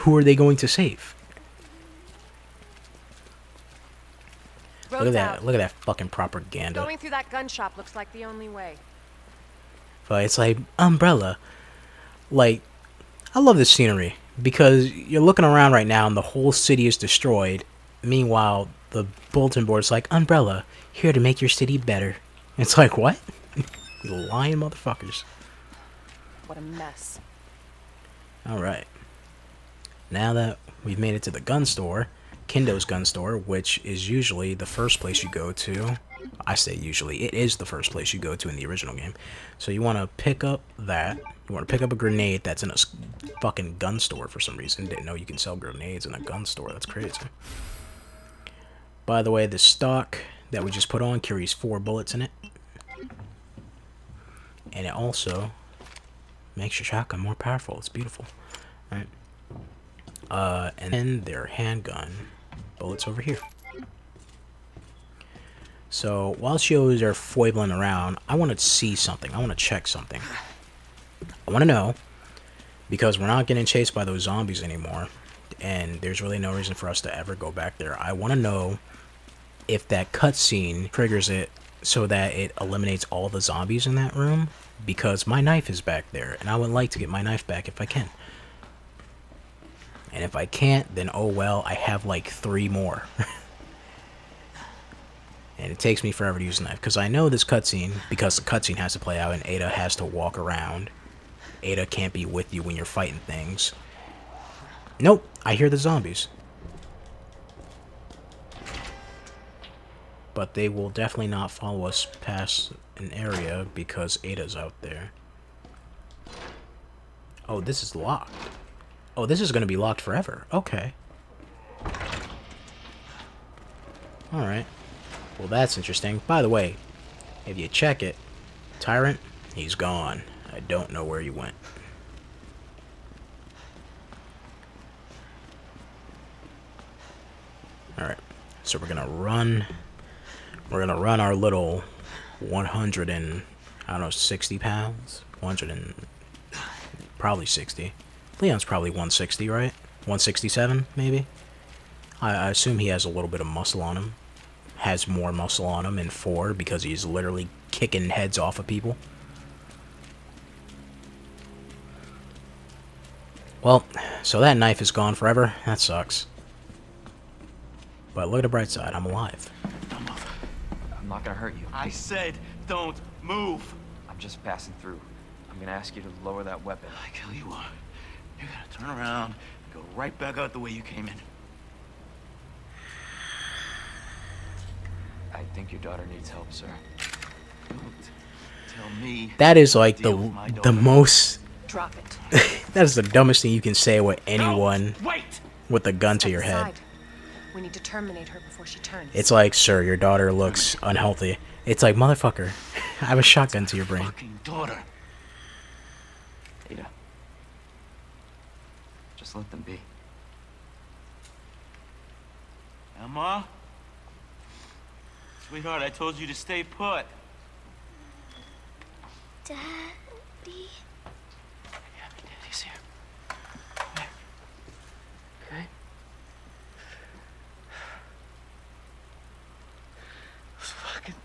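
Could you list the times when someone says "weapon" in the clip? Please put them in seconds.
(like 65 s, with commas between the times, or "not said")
176 s.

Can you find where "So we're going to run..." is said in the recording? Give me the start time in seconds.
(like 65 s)
138 s.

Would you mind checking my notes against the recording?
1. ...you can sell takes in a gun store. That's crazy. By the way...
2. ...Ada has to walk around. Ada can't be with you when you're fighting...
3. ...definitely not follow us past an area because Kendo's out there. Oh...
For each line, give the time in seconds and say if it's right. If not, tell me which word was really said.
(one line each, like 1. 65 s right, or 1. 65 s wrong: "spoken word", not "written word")
1. 45 s wrong: "grenades", not "takes"
2. 99 s right
3. 110 s wrong: "Ada", not "Kendo".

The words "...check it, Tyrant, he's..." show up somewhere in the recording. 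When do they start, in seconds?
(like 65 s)
127 s.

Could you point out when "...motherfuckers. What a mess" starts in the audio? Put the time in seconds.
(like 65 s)
24 s.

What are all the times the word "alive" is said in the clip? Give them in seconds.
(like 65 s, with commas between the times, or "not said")
169 s.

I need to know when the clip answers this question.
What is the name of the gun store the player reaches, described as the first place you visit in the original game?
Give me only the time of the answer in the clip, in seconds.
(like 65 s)
32 s.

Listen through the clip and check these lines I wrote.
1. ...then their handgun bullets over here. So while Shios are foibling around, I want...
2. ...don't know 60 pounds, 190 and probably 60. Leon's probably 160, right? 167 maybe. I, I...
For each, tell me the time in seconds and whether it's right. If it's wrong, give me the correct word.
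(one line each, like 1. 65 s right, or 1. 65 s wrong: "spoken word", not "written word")
1. 60 s right
2. 143 s wrong: "100", not "190".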